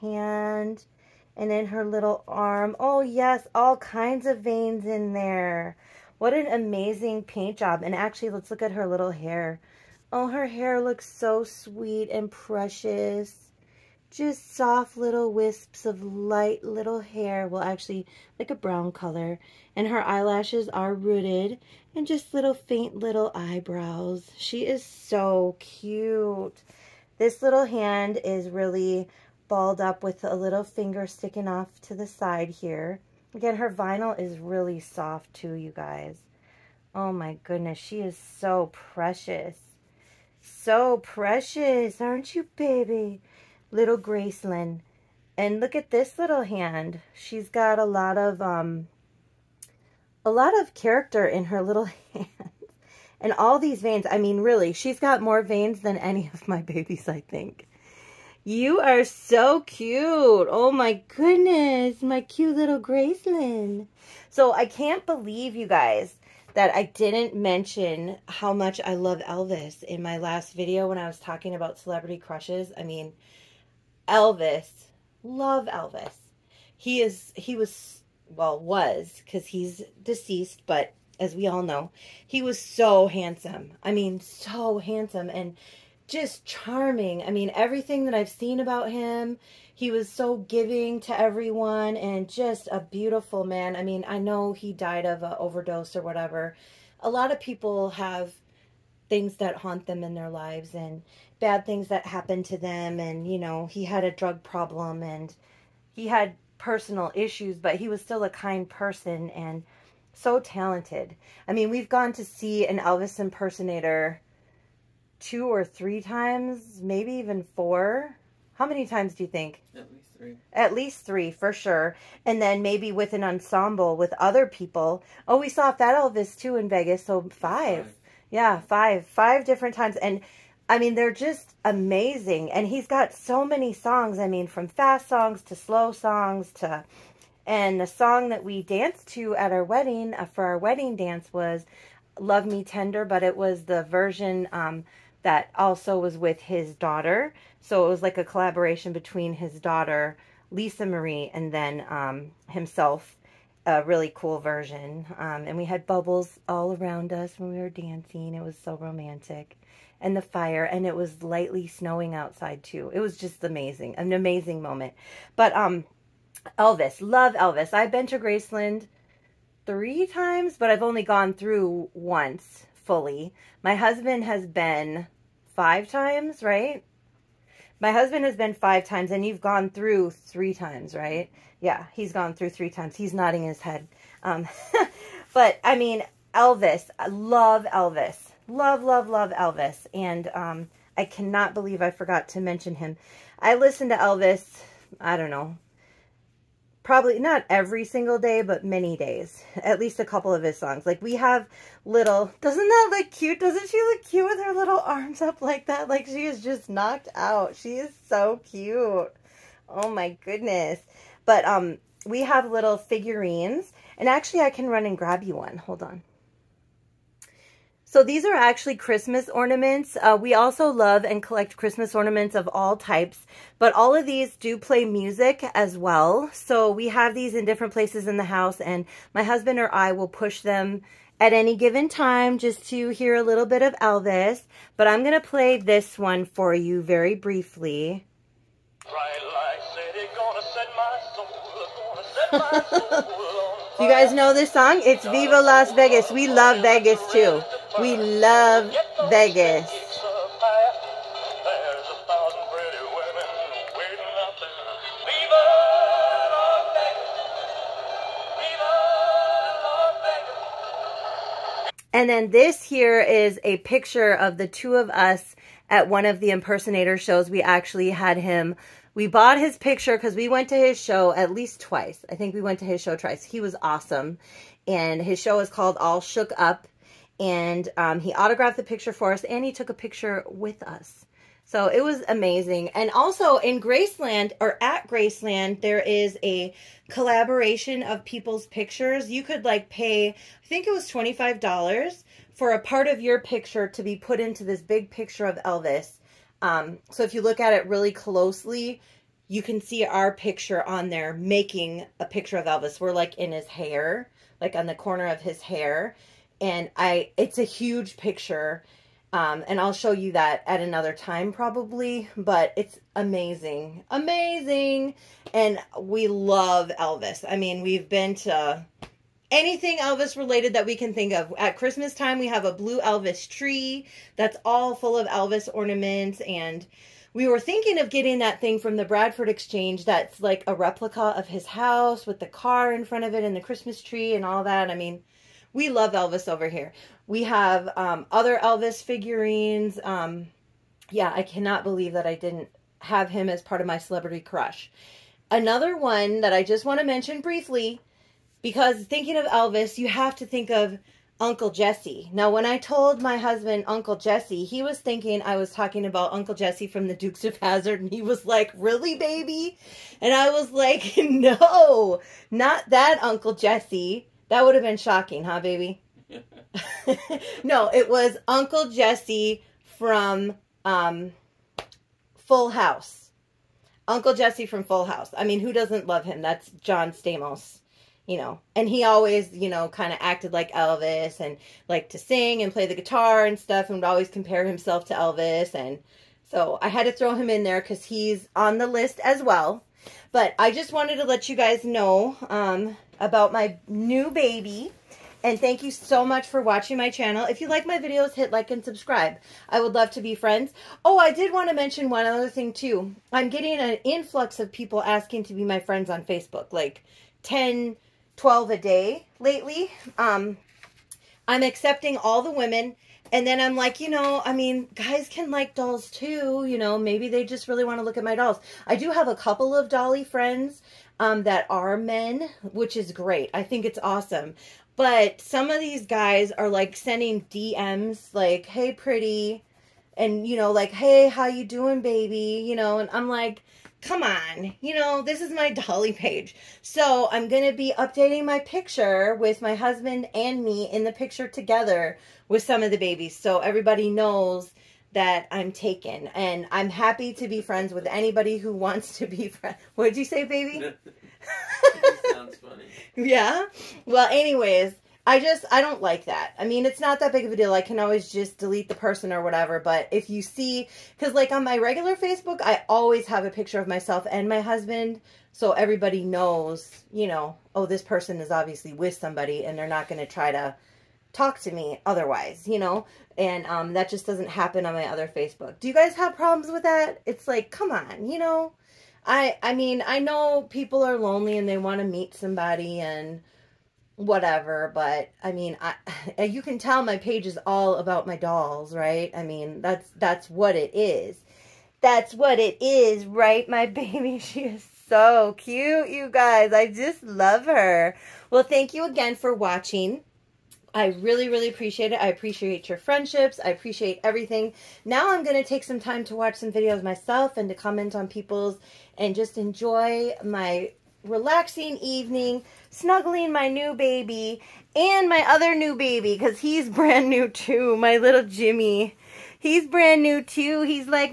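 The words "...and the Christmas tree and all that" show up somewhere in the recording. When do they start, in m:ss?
5:33.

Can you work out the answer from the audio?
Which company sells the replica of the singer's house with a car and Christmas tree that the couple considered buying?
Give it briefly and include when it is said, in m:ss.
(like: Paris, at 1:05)
Bradford Exchange, at 5:28.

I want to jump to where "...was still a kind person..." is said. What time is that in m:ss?
1:47.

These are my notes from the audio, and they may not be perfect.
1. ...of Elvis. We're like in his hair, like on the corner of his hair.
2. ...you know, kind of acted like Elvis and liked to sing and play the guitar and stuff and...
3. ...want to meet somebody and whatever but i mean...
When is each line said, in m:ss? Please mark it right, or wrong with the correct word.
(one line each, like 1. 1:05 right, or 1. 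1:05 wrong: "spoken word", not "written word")
1. 5:02 right
2. 6:19 right
3. 8:01 right.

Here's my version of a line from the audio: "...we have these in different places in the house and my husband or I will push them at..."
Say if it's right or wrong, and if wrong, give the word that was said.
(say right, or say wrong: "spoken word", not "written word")
right.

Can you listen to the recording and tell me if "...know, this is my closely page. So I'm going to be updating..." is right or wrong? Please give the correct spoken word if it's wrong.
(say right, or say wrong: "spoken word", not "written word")
wrong: "dolly", not "closely".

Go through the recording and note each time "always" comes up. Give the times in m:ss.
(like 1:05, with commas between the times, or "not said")
6:18, 6:23, 7:37, 7:42.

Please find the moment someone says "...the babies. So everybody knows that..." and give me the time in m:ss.
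7:22.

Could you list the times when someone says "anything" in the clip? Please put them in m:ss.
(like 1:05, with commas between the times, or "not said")
5:19.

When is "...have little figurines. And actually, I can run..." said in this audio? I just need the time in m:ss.
3:32.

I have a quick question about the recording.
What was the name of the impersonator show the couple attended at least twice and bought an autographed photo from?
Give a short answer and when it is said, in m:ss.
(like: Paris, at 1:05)
All Shook Up, at 4:35.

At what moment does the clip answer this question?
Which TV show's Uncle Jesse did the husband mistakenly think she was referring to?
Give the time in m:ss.
5:56.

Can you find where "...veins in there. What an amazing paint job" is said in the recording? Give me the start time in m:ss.
0:04.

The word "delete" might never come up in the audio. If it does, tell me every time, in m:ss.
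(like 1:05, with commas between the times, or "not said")
7:38.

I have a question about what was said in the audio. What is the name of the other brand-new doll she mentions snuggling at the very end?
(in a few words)
Jimmy.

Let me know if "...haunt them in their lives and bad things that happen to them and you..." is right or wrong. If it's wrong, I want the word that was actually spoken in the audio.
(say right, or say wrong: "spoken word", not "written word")
right.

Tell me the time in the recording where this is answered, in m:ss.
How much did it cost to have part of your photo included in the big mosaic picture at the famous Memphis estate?
4:50.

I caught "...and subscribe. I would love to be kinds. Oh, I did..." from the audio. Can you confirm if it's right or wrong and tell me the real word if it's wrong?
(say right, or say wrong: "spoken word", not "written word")
wrong: "friends", not "kinds".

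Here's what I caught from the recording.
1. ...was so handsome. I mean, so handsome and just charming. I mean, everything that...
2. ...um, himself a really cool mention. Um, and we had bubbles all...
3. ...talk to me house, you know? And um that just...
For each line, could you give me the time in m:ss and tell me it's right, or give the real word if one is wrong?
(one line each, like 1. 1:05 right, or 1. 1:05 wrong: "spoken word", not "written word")
1. 1:22 right
2. 2:31 wrong: "version", not "mention"
3. 7:51 wrong: "otherwise", not "house".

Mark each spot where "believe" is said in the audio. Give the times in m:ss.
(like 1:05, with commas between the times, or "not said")
1:05, 3:11, 5:41.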